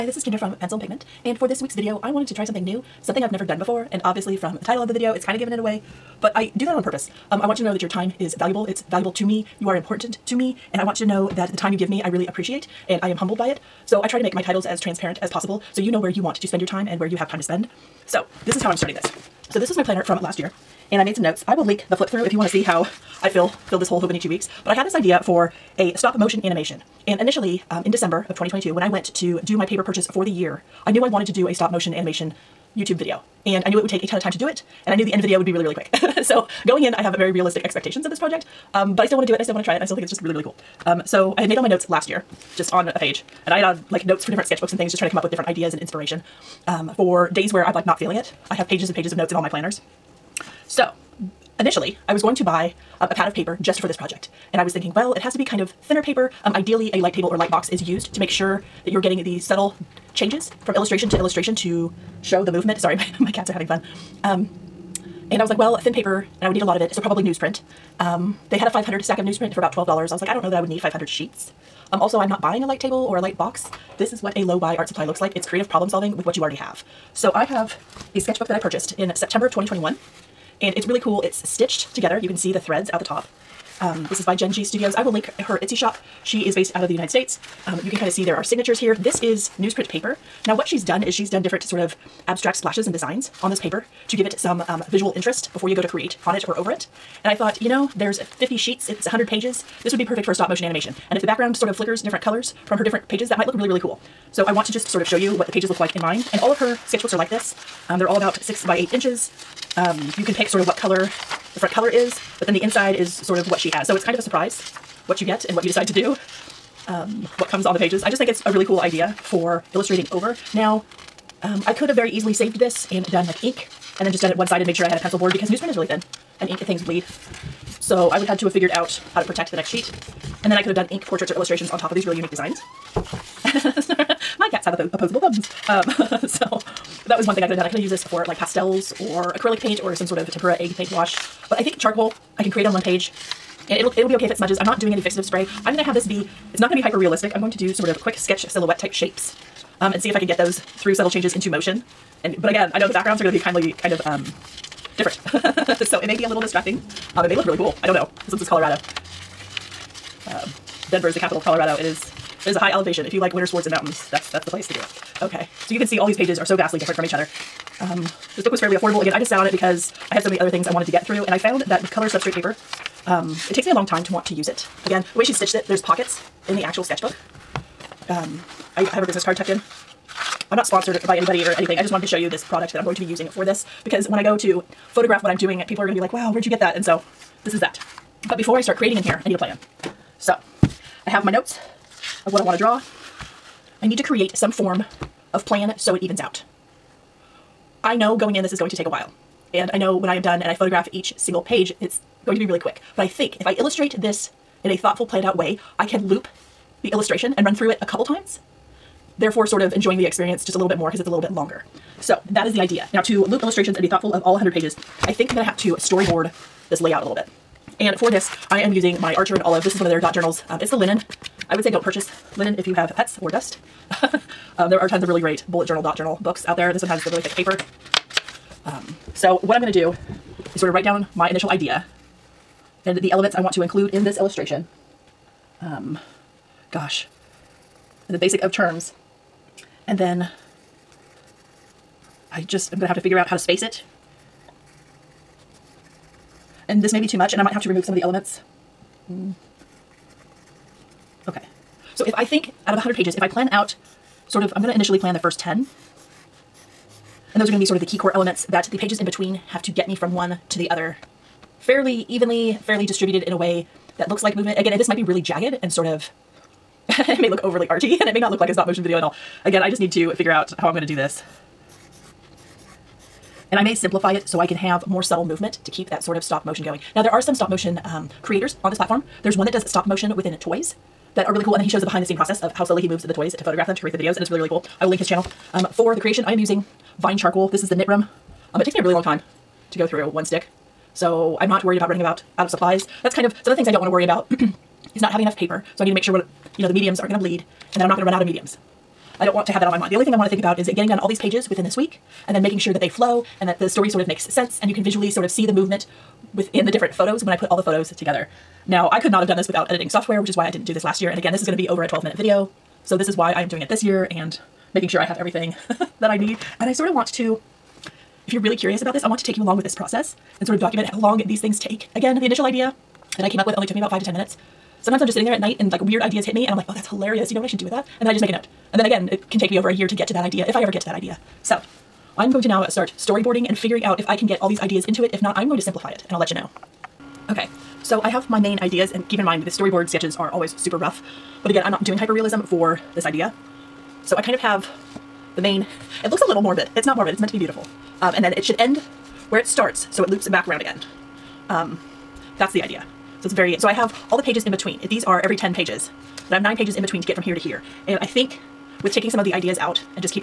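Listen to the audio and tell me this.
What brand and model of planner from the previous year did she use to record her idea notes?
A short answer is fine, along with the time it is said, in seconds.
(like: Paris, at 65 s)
Hobonichi Weeks, at 24 s.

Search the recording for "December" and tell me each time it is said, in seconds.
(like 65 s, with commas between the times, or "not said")
27 s.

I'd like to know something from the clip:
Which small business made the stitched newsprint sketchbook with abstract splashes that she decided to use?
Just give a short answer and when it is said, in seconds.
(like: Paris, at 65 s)
Jen G Studios, at 84 s.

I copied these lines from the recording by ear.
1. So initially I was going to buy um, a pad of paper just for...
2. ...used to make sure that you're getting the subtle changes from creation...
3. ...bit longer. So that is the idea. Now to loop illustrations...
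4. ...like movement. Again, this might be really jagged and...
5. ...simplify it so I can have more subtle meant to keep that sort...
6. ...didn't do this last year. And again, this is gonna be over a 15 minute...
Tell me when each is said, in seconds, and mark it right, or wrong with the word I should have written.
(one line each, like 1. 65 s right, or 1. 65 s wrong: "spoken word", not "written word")
1. 50 s right
2. 57 s wrong: "illustration", not "creation"
3. 211 s right
4. 264 s right
5. 273 s wrong: "movement", not "meant"
6. 310 s wrong: "12", not "15".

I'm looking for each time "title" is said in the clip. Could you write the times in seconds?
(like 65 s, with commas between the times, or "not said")
4 s, 14 s.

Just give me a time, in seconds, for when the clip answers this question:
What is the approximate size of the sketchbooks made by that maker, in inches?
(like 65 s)
108 s.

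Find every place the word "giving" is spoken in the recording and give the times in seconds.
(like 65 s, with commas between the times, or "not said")
5 s.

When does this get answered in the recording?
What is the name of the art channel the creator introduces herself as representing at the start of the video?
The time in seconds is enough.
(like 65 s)
0 s.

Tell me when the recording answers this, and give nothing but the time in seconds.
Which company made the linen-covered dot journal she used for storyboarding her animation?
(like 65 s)
219 s.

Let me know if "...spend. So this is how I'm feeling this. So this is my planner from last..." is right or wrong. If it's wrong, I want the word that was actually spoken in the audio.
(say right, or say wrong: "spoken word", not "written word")
wrong: "starting", not "feeling".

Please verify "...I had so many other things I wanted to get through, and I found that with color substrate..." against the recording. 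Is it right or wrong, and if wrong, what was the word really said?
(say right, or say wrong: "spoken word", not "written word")
right.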